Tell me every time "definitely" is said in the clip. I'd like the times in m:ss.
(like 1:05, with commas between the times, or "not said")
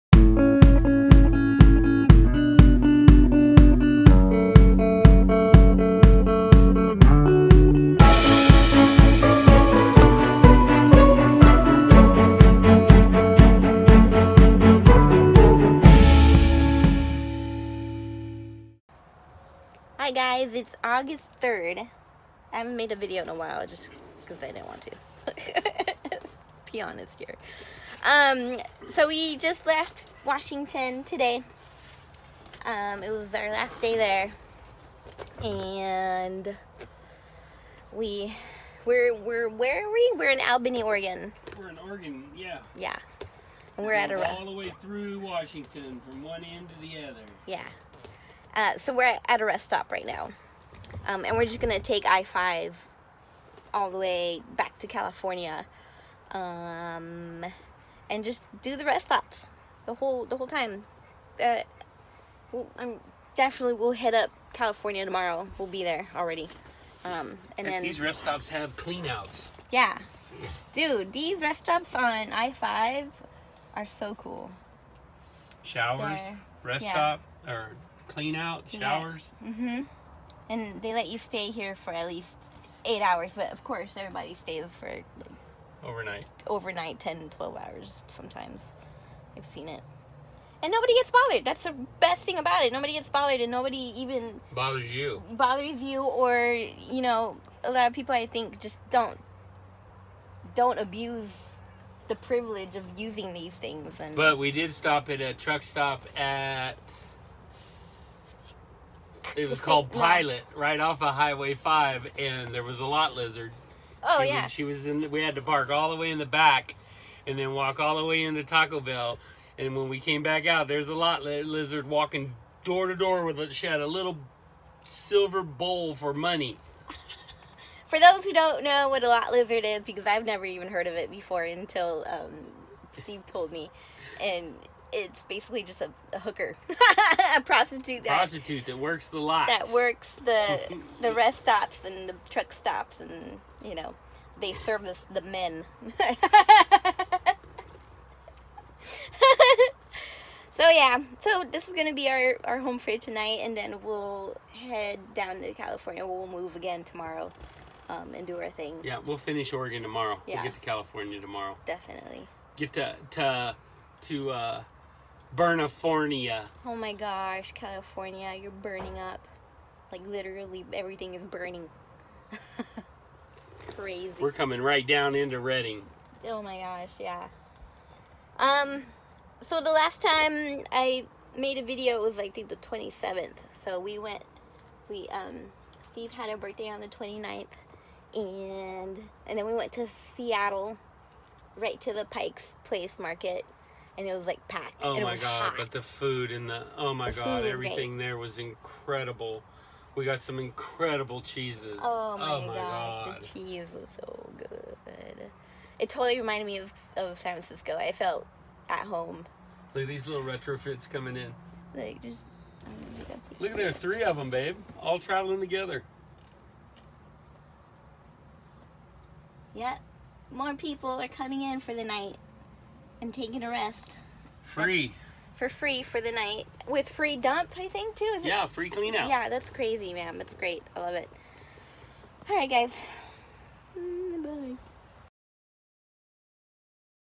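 1:03, 2:41.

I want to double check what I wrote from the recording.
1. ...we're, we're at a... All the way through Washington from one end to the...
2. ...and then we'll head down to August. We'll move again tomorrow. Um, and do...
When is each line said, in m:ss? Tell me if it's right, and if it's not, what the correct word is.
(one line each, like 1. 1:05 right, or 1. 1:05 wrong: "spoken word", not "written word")
1. 0:43 right
2. 2:33 wrong: "California", not "August".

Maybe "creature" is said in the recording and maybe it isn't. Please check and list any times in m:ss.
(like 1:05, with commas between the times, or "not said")
not said.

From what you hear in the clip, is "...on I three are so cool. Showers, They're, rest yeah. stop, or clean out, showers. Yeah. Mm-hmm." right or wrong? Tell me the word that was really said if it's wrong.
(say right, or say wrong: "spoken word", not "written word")
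wrong: "five", not "three".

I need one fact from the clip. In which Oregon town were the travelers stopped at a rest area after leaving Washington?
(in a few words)
Albany.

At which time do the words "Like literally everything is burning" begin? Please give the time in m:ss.
2:49.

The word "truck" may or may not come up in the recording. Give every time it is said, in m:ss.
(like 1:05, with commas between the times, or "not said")
1:45, 2:22.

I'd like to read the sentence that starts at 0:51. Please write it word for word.
Um, and we're just gonna take I-5 all the way back to California.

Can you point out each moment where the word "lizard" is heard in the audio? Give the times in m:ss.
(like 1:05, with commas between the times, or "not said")
1:53, 2:01, 2:09.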